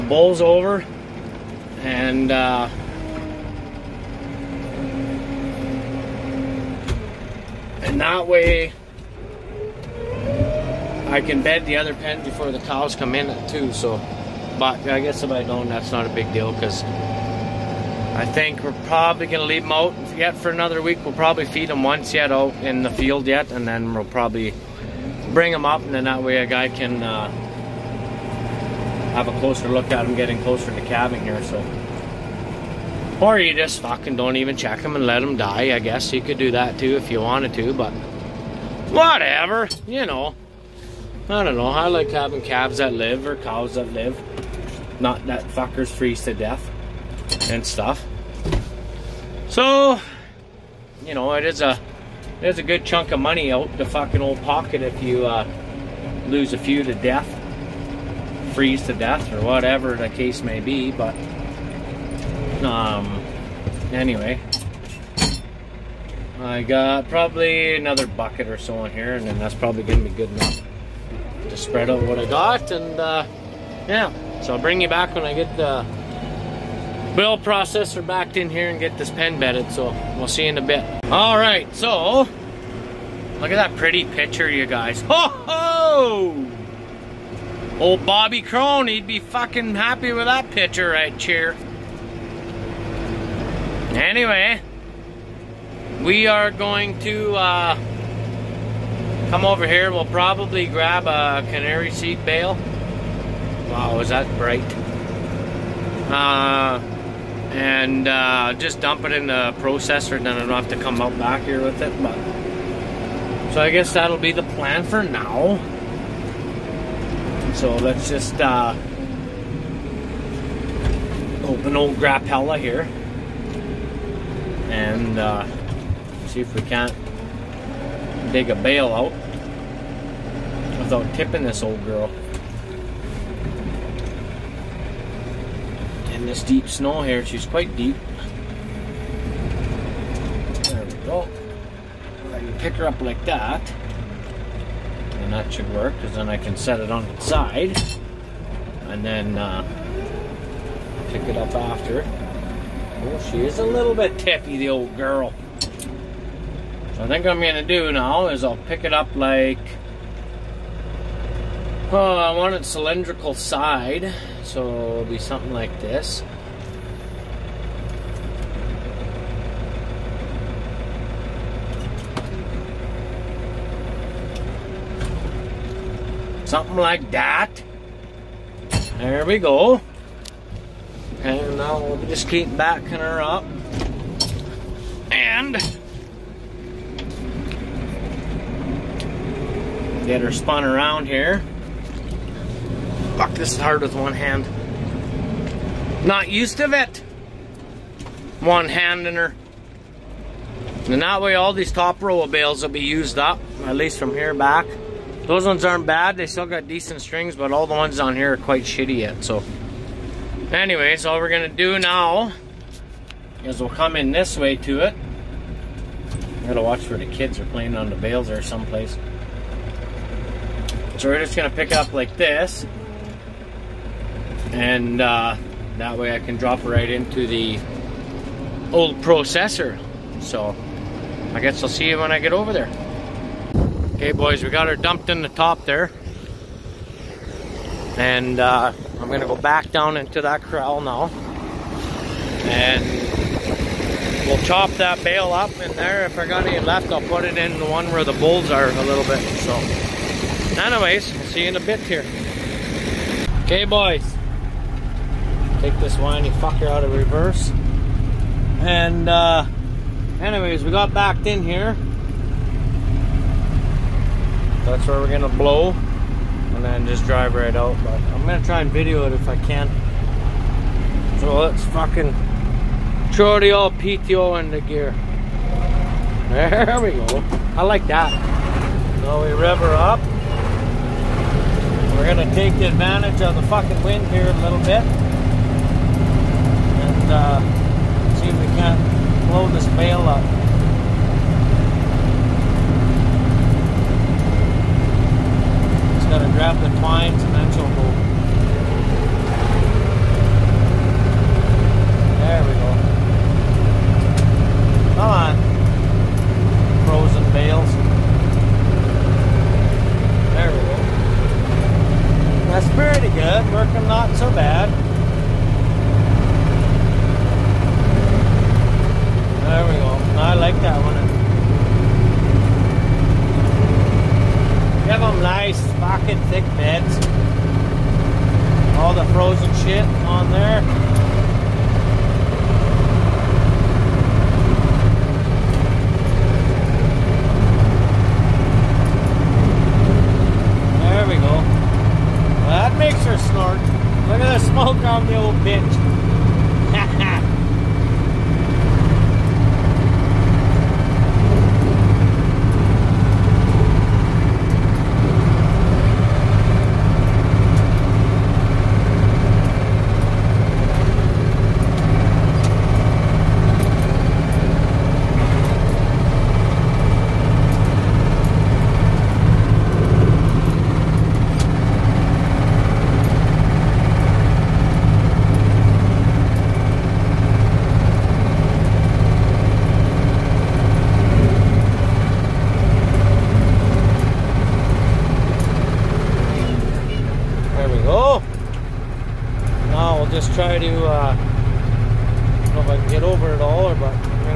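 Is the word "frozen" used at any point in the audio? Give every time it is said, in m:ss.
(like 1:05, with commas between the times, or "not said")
5:06, 5:29.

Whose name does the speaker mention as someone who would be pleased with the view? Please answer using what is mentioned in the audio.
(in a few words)
Bobby Crone.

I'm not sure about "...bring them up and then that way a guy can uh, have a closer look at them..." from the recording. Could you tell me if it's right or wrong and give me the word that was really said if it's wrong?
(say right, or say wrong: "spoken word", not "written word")
right.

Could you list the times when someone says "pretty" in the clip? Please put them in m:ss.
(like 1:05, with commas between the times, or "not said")
1:23, 5:12.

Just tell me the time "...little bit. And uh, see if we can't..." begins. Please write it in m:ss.
4:44.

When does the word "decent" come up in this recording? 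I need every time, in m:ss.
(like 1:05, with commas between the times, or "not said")
3:26.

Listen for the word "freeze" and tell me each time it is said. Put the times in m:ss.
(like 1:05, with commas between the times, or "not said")
0:45, 0:58.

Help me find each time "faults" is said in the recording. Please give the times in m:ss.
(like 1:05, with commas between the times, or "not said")
not said.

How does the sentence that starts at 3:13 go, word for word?
Fuck, this is hard with one hand.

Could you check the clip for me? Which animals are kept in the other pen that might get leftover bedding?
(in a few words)
bulls.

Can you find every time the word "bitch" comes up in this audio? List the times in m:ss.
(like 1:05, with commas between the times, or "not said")
5:45.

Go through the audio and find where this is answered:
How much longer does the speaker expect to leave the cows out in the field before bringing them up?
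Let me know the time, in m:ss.
0:20.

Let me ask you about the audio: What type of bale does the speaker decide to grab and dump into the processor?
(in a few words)
canary seed bale.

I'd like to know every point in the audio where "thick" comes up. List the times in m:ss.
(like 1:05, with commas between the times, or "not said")
5:26.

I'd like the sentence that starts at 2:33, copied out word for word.
Oh, she is a little bit tippy, the old girl.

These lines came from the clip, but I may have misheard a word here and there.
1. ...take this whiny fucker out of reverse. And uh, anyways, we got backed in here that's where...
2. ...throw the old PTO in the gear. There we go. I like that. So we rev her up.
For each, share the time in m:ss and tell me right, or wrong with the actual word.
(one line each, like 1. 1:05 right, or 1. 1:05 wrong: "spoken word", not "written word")
1. 4:15 right
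2. 4:33 right.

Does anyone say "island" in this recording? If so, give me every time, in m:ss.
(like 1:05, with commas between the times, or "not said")
not said.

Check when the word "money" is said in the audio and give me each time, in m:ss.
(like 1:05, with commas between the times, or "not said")
0:53.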